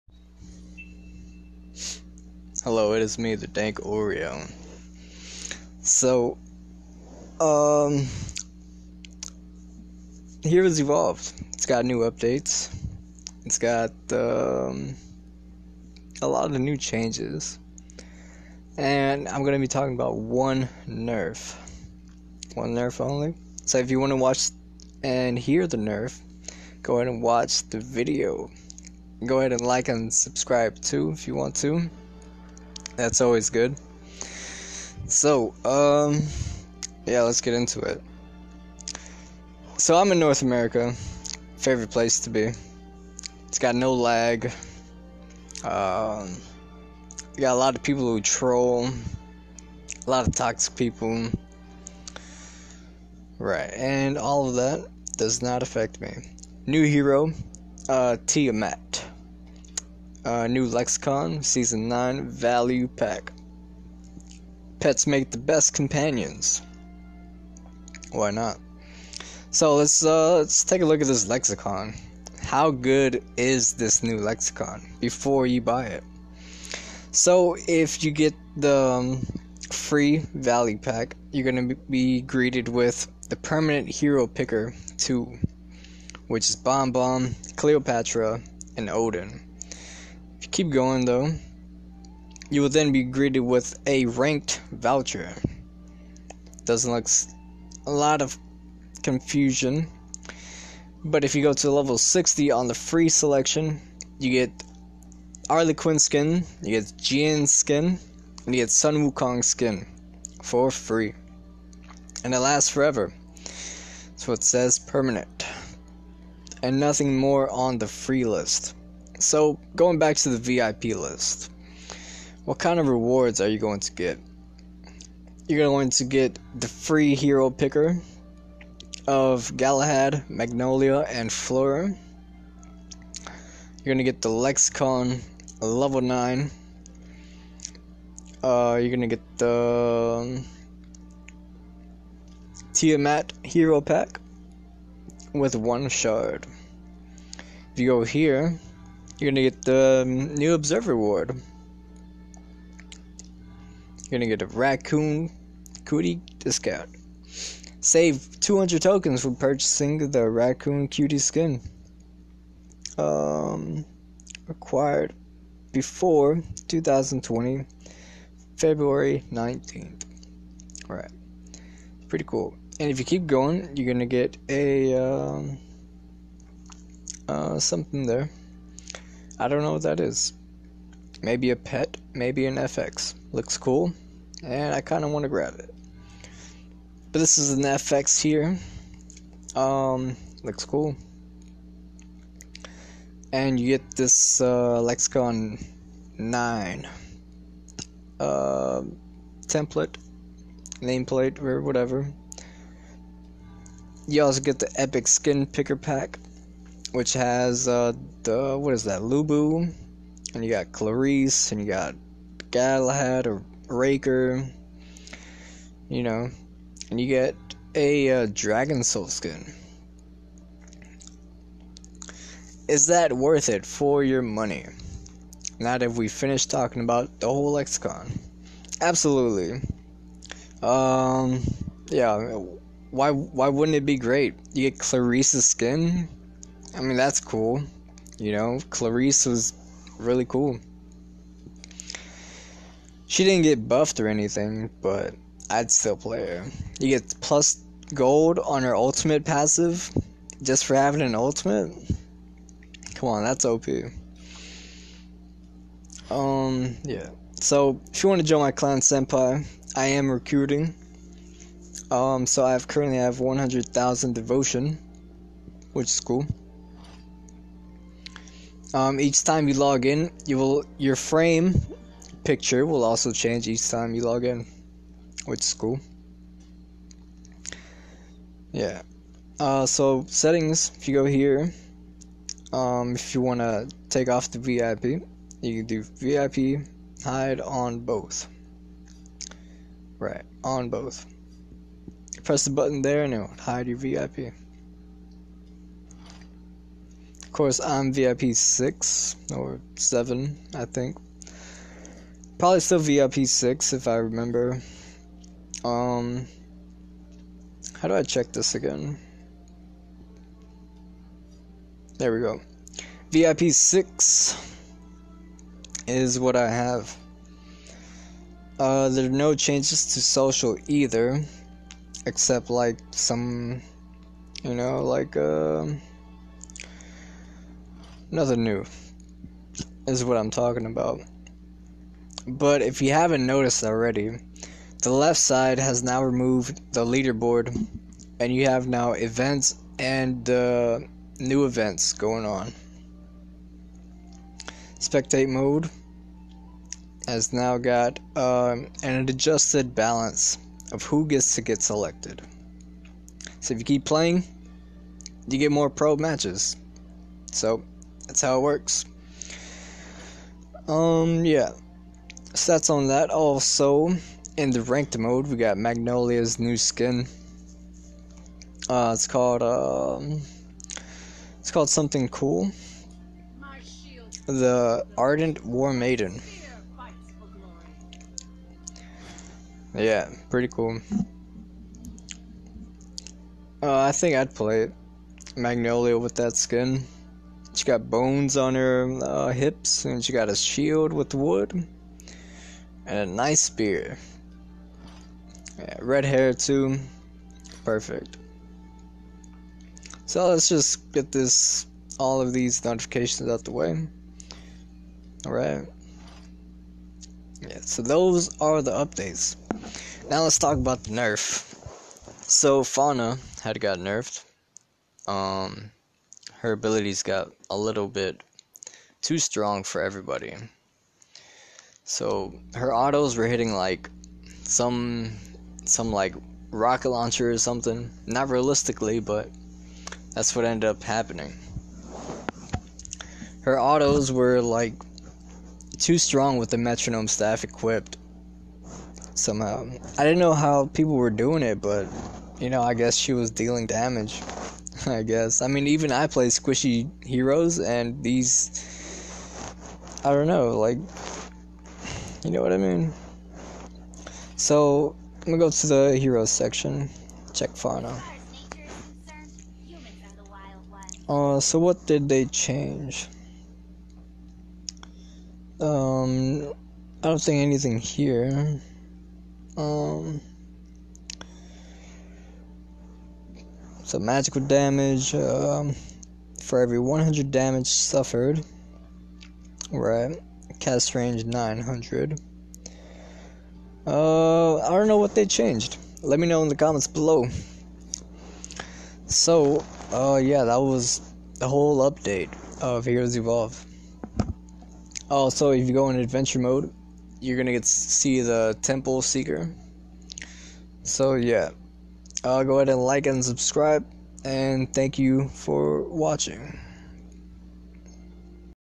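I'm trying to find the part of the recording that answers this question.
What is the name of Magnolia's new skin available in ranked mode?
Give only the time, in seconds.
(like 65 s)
374 s.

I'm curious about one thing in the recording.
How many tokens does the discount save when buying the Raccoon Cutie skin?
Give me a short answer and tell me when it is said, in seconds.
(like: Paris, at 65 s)
200, at 158 s.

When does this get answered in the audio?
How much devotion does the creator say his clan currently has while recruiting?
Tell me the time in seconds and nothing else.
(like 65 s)
263 s.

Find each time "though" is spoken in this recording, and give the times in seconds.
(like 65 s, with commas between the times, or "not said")
91 s.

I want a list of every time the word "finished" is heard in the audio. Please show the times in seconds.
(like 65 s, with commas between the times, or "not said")
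226 s.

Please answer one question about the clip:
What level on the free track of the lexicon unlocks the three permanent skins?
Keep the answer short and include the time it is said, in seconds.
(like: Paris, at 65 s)
60, at 101 s.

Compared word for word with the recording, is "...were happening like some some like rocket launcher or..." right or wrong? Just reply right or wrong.
wrong.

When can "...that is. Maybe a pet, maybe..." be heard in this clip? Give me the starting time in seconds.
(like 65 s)
179 s.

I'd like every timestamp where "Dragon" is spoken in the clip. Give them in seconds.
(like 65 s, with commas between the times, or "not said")
218 s.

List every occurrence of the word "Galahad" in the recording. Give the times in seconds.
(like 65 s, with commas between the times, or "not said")
129 s, 212 s.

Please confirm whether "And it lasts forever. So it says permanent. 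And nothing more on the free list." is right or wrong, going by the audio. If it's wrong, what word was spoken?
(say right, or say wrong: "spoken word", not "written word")
right.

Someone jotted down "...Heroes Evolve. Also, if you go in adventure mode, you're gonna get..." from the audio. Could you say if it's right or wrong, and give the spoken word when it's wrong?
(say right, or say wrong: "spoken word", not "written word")
right.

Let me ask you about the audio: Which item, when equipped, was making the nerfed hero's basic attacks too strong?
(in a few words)
metronome staff.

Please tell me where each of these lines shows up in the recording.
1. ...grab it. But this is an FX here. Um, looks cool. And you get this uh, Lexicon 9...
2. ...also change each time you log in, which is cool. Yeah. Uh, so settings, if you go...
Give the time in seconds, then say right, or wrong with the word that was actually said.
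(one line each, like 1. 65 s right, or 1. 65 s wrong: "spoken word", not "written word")
1. 185 s right
2. 272 s right.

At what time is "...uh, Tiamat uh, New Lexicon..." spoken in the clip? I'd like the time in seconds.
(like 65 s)
57 s.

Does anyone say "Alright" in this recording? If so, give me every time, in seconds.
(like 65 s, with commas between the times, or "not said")
170 s.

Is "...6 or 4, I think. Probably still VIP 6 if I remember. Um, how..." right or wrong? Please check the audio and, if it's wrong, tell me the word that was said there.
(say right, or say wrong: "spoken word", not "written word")
wrong: "7", not "4".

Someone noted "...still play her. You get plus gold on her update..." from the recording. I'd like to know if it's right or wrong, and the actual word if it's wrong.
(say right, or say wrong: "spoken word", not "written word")
wrong: "ultimate", not "update".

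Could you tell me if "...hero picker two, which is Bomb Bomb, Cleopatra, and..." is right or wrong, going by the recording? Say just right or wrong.
right.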